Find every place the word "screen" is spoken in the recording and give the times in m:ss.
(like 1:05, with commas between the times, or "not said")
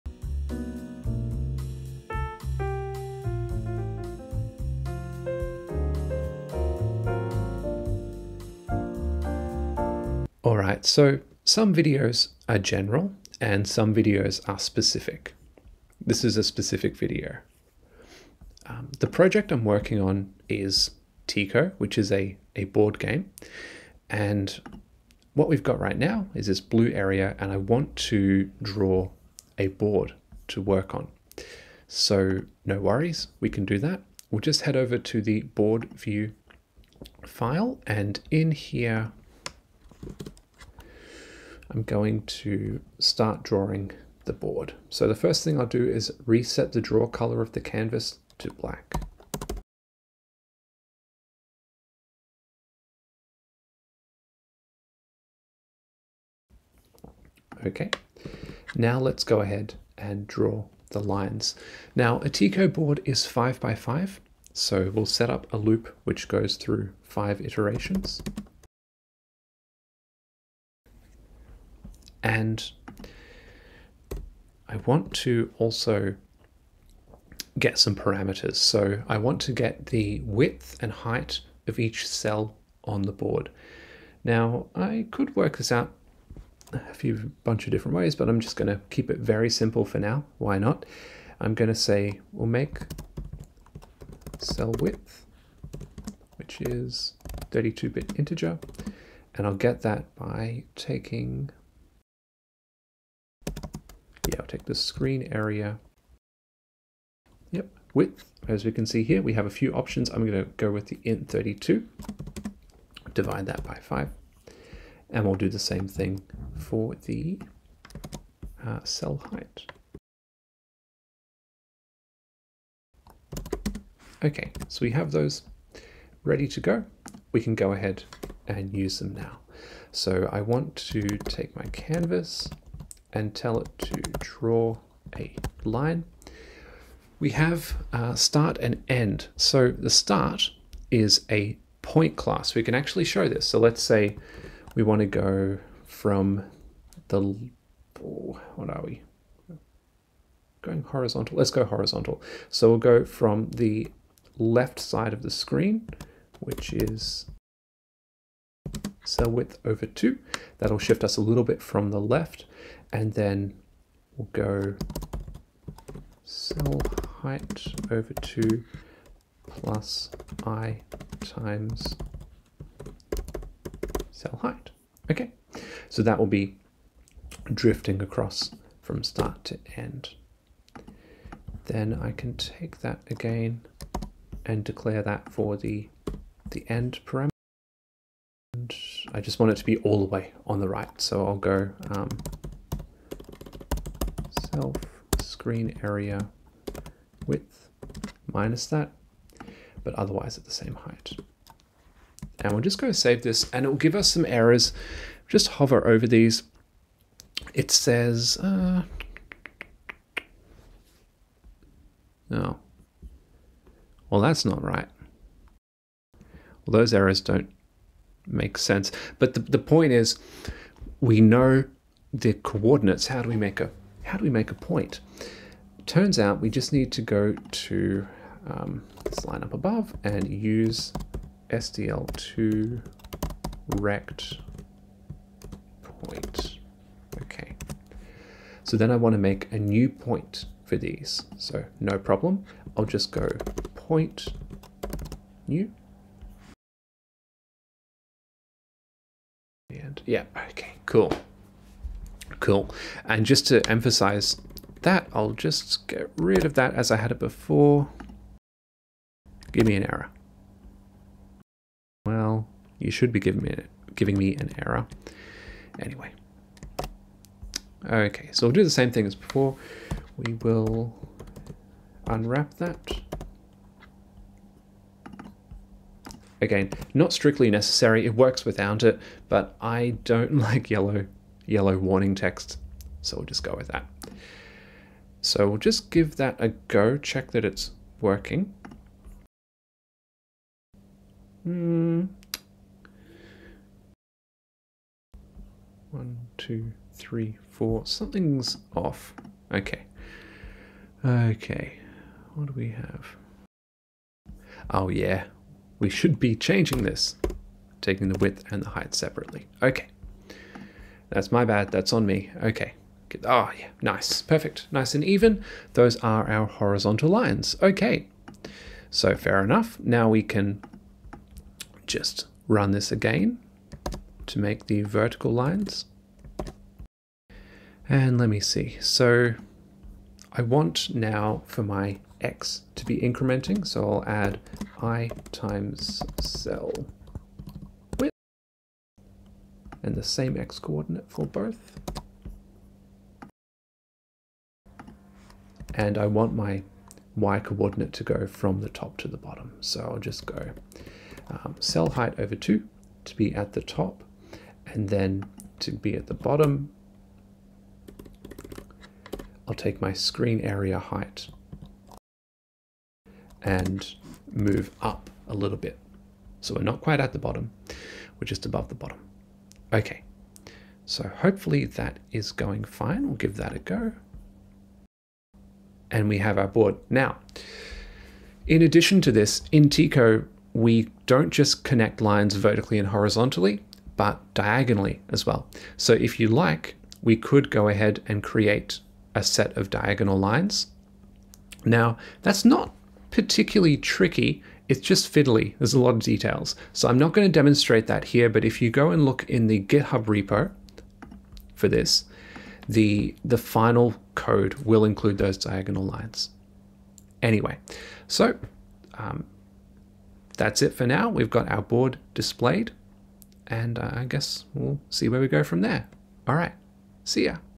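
1:44, 2:35, 3:15, 5:59.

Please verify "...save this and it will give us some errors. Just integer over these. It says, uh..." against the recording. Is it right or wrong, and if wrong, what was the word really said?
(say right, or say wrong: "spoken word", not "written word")
wrong: "hover", not "integer".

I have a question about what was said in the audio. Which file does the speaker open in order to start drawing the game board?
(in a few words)
board view.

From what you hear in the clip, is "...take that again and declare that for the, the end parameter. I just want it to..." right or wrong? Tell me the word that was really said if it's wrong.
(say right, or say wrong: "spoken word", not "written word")
right.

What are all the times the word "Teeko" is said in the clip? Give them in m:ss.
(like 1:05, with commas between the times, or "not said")
0:21, 1:02, 6:19.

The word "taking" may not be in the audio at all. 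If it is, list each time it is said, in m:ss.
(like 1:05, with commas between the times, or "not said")
1:40, 5:07.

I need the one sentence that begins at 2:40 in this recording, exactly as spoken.
That'll shift us a little bit from the left.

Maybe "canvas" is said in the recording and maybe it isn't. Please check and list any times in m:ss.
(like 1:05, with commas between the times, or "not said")
0:47, 2:11.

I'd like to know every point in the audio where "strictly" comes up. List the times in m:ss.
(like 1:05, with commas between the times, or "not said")
4:37.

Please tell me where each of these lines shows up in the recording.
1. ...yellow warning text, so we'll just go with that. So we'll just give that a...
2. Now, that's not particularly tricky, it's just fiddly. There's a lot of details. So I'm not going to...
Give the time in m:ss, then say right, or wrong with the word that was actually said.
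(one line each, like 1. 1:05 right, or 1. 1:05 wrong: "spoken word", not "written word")
1. 4:41 right
2. 6:31 right.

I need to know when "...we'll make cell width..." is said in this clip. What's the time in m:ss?
1:32.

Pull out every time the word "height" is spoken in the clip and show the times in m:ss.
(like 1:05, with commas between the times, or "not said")
1:20, 1:59, 2:47, 2:54, 3:20, 5:08, 5:51, 6:00.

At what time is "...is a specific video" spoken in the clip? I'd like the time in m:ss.
0:16.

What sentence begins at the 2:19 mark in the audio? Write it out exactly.
So the start is a point class.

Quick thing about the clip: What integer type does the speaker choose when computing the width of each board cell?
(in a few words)
int 32.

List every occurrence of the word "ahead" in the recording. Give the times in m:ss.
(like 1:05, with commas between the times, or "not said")
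0:59, 2:07, 6:27.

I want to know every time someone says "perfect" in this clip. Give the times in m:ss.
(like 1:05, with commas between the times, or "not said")
5:14.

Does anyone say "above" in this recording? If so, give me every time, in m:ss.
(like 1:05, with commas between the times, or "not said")
3:49, 6:08.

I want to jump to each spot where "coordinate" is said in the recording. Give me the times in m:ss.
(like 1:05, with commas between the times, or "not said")
3:42, 5:40, 5:47.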